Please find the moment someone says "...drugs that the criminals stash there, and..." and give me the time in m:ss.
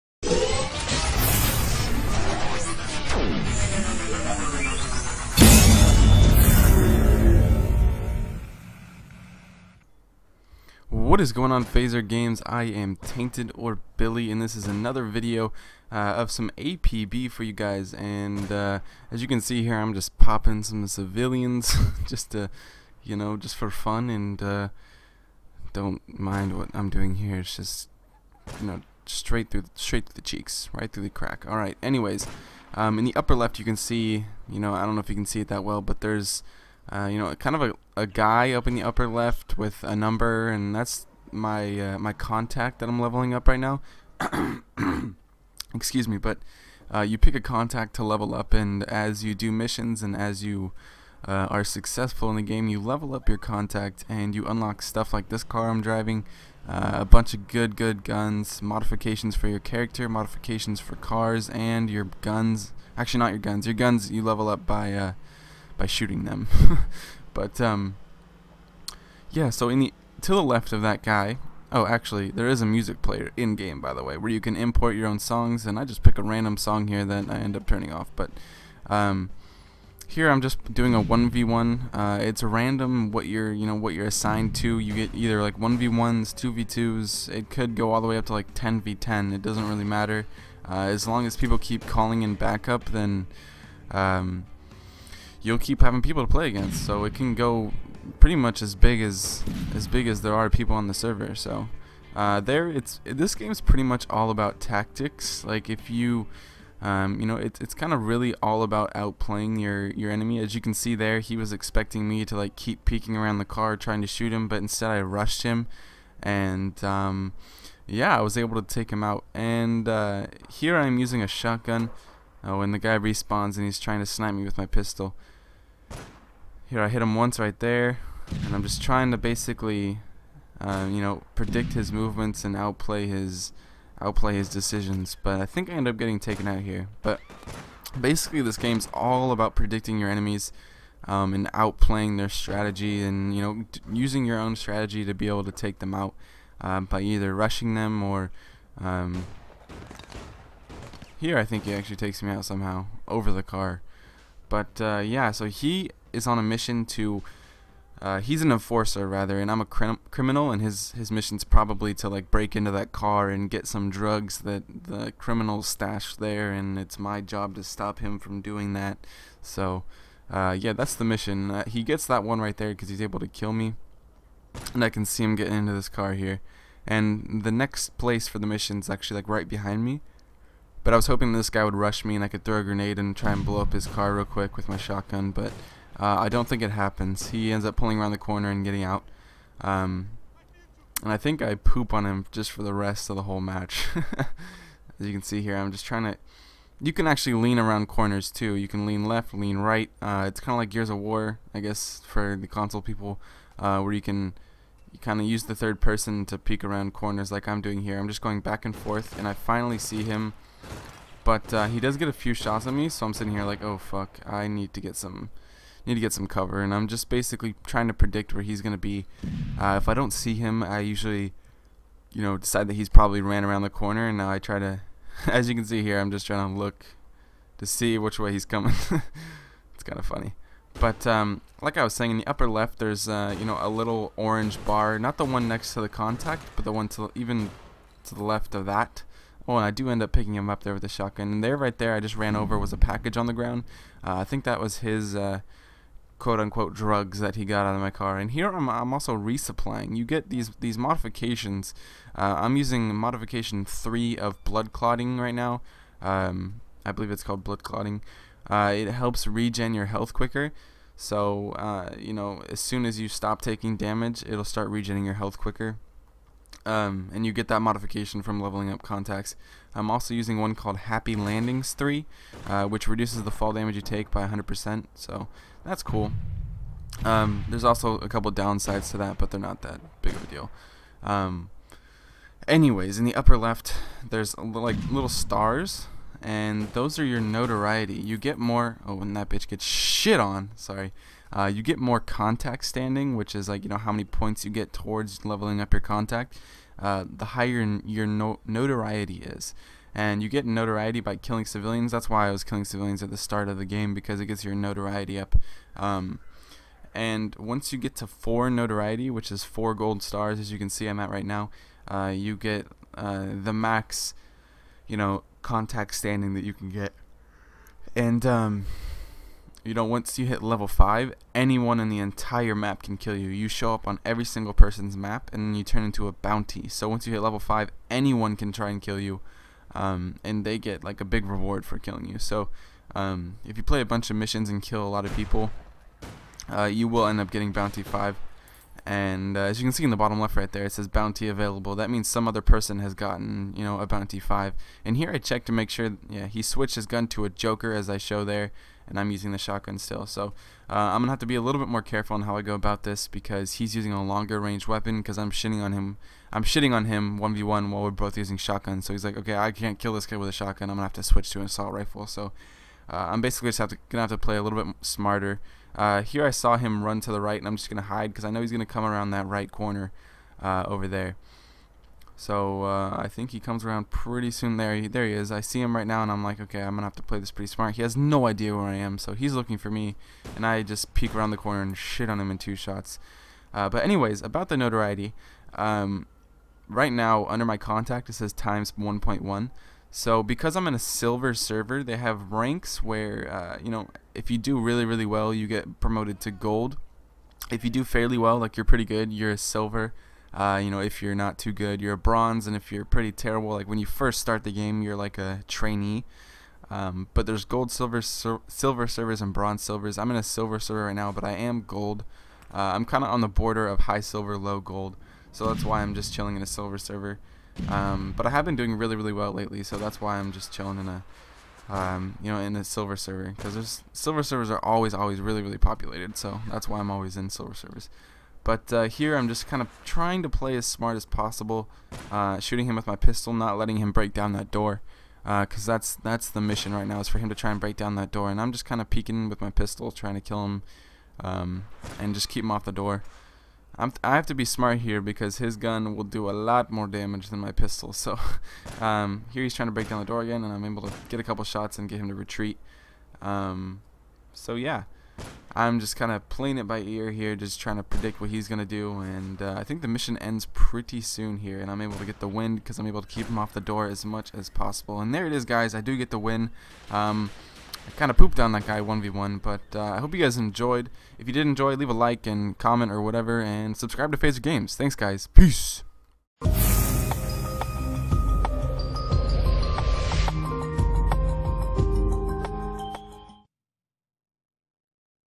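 2:43.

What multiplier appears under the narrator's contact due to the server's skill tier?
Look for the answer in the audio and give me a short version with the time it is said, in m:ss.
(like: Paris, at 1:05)
1.1, at 6:28.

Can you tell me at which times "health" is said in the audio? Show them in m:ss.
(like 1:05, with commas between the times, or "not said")
4:19, 4:25.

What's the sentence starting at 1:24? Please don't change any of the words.
You get either like 1v1s, 2v2s.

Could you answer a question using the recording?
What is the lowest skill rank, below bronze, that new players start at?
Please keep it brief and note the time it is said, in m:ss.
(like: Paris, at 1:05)
Trainee, at 6:45.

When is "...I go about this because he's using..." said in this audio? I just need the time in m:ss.
5:52.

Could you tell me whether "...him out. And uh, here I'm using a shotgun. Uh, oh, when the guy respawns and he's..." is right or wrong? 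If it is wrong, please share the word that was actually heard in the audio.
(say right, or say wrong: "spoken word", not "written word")
right.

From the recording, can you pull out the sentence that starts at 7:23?
I'm I have to be smart here because his gun will do a lot more damage than my pistol.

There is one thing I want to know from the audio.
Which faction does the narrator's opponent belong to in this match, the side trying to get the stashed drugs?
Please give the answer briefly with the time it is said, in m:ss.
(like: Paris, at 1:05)
Enforcer, at 2:38.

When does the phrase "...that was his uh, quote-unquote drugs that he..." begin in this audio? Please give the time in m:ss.
4:04.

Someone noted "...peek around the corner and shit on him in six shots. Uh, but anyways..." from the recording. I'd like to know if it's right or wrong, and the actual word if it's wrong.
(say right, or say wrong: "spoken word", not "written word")
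wrong: "two", not "six".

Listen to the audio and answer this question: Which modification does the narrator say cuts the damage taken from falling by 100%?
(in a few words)
Happy Landings 3.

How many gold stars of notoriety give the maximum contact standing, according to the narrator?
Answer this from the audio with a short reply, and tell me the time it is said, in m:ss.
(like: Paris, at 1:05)
4, at 5:09.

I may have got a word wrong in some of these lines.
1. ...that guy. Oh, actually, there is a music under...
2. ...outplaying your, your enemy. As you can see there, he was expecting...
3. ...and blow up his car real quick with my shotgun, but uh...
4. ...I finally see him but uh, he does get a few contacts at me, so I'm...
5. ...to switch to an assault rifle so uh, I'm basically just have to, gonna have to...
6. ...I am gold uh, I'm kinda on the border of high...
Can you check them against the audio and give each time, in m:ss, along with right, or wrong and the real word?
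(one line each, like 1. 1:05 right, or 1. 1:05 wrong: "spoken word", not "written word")
1. 1:10 wrong: "player", not "under"
2. 1:48 right
3. 3:03 right
4. 3:29 wrong: "shots", not "contacts"
5. 6:00 right
6. 6:51 right.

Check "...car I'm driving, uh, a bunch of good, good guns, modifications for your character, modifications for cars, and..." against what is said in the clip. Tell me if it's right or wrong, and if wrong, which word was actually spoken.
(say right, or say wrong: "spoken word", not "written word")
right.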